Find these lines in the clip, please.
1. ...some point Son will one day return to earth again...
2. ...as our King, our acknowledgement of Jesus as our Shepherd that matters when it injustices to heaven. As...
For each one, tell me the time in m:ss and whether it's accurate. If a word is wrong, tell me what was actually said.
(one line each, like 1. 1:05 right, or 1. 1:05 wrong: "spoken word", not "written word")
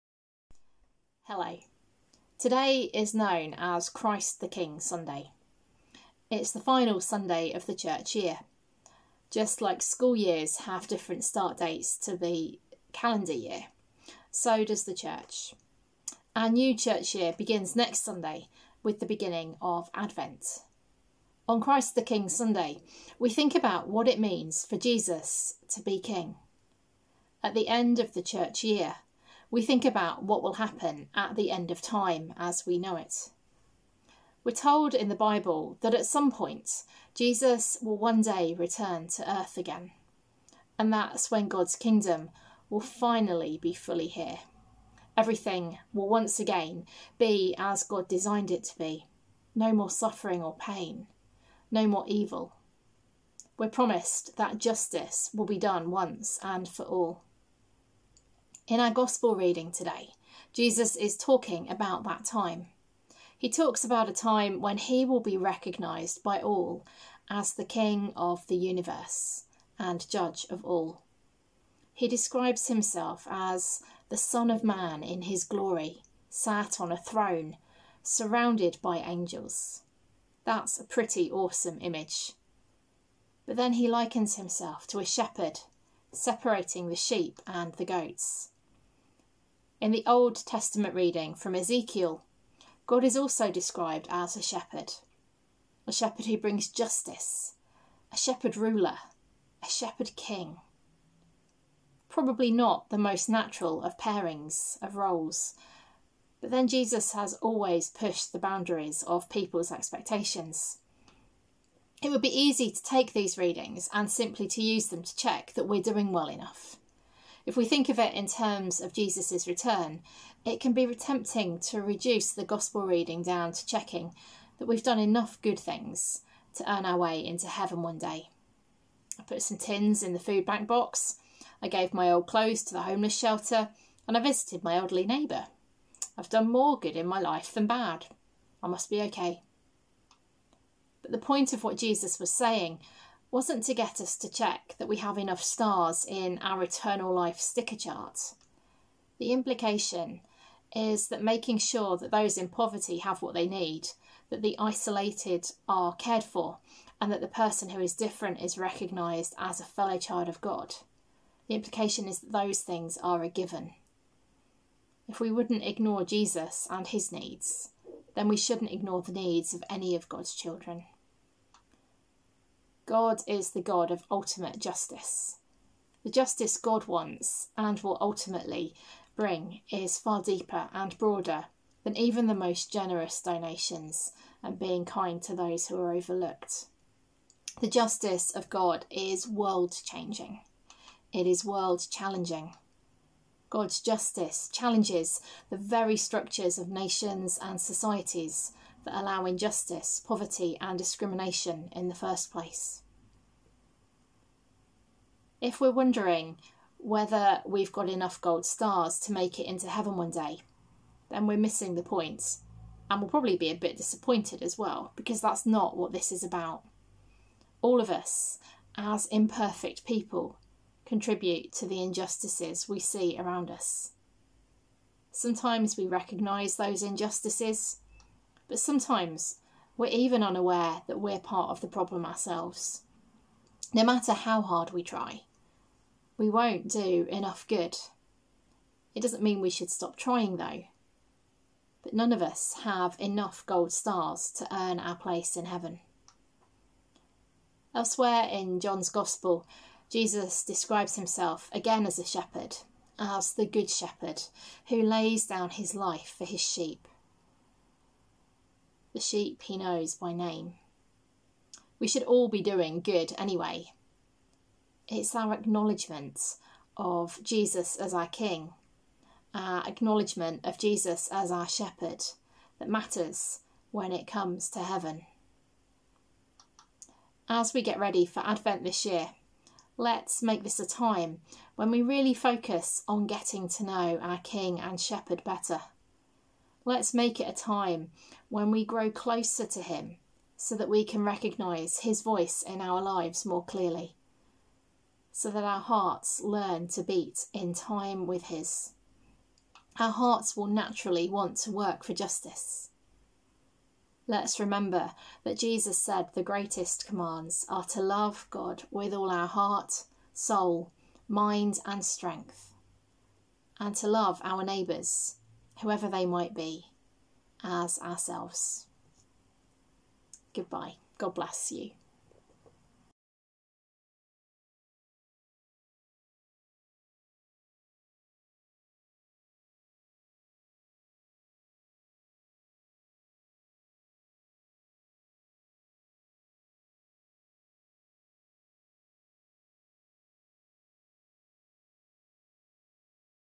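1. 0:36 wrong: "Jesus", not "Son"
2. 4:27 wrong: "comes", not "injustices".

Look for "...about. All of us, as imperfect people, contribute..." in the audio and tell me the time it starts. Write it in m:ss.
3:36.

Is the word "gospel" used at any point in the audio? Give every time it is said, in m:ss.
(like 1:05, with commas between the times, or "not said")
0:58, 2:02, 4:08.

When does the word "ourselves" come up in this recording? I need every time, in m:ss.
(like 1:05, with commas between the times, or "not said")
3:52, 5:17.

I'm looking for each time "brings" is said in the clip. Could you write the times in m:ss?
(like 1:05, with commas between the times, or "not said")
1:36, 2:59.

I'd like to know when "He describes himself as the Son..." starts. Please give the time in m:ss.
1:11.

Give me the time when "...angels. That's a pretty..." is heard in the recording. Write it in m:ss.
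1:18.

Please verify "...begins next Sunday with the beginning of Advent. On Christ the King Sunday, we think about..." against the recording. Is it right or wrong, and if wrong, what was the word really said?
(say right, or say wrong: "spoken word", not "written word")
right.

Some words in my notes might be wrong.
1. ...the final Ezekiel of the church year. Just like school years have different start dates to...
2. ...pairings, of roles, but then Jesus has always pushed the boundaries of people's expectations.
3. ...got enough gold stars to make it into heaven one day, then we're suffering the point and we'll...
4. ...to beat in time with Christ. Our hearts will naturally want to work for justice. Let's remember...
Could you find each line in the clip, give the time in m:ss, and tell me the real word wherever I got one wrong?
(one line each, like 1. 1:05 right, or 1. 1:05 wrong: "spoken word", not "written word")
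1. 0:06 wrong: "Sunday", not "Ezekiel"
2. 1:43 right
3. 3:27 wrong: "missing", not "suffering"
4. 4:56 wrong: "His", not "Christ".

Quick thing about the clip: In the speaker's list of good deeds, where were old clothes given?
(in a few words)
The homeless shelter.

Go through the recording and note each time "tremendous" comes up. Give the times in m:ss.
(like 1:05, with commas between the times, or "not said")
not said.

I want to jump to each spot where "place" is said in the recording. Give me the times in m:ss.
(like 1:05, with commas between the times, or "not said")
3:22, 4:04.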